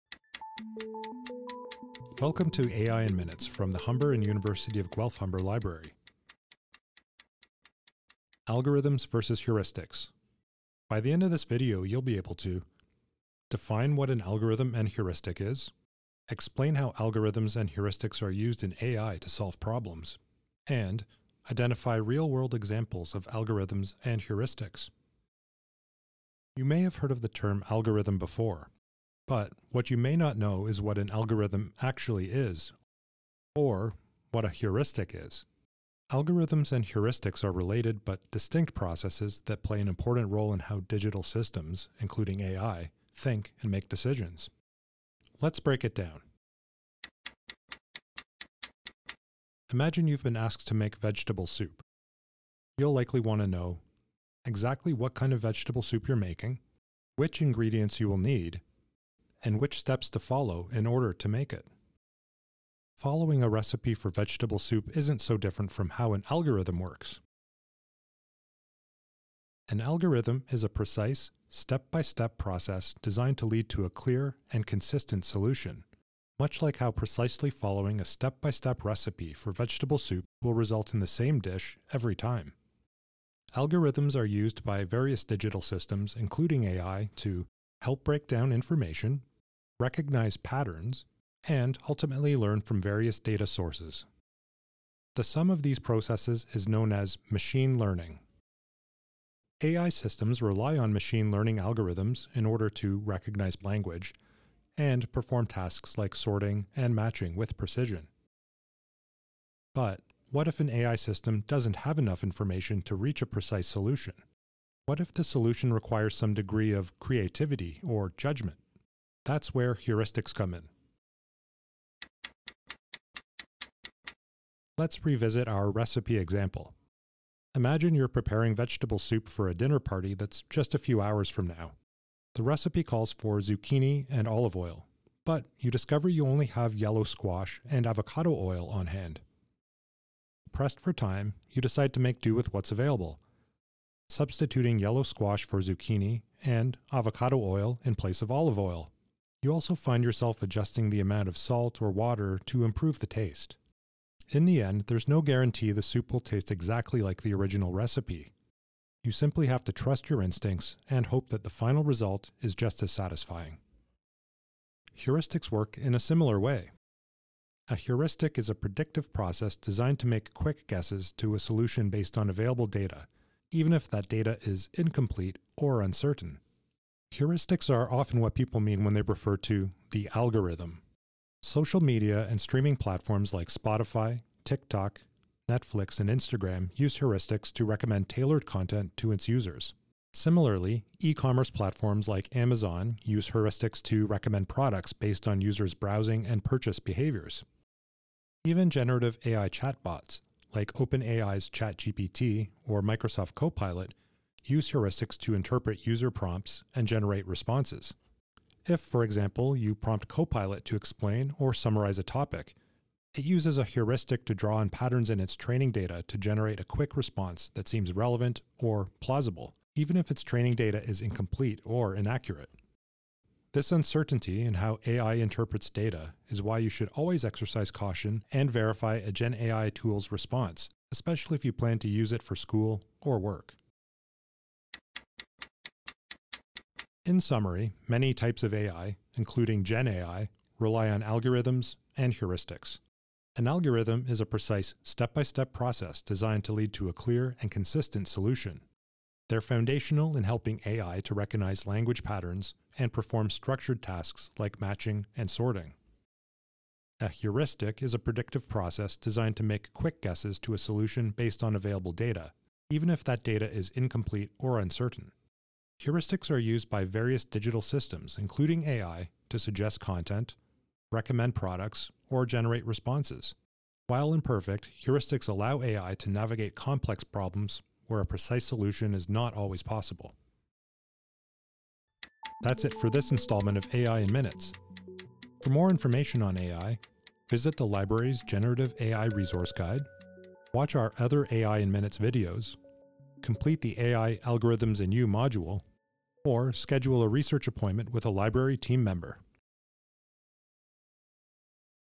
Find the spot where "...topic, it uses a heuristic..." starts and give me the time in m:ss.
3:32.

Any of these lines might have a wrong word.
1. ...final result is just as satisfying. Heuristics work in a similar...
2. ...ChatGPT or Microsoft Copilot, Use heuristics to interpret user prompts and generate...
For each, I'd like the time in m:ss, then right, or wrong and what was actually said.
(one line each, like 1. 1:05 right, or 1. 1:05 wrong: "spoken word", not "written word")
1. 2:41 right
2. 3:21 right.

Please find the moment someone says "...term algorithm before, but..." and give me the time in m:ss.
0:27.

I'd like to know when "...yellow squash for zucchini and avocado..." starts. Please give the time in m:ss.
2:24.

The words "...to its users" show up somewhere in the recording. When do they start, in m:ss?
3:08.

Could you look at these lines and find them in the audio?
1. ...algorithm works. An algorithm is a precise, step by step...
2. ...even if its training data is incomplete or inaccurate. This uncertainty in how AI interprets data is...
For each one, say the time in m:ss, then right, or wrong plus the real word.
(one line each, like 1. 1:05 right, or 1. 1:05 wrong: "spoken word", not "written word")
1. 1:06 right
2. 3:39 right.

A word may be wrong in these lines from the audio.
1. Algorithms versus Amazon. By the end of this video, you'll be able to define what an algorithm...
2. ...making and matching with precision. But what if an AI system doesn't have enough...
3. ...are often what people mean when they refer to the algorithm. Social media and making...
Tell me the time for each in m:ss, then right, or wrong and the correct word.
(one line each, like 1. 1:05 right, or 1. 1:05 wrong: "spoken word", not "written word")
1. 0:08 wrong: "Heuristics", not "Amazon"
2. 1:46 wrong: "sorting", not "making"
3. 2:57 wrong: "streaming", not "making".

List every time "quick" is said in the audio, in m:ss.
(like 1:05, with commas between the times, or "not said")
2:50, 3:36, 4:19.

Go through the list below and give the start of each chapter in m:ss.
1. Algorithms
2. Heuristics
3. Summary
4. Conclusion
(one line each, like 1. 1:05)
1. 0:47
2. 2:02
3. 3:55
4. 4:42.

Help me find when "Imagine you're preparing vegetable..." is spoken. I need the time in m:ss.
2:07.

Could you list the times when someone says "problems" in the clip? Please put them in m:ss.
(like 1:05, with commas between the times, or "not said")
0:19, 4:37.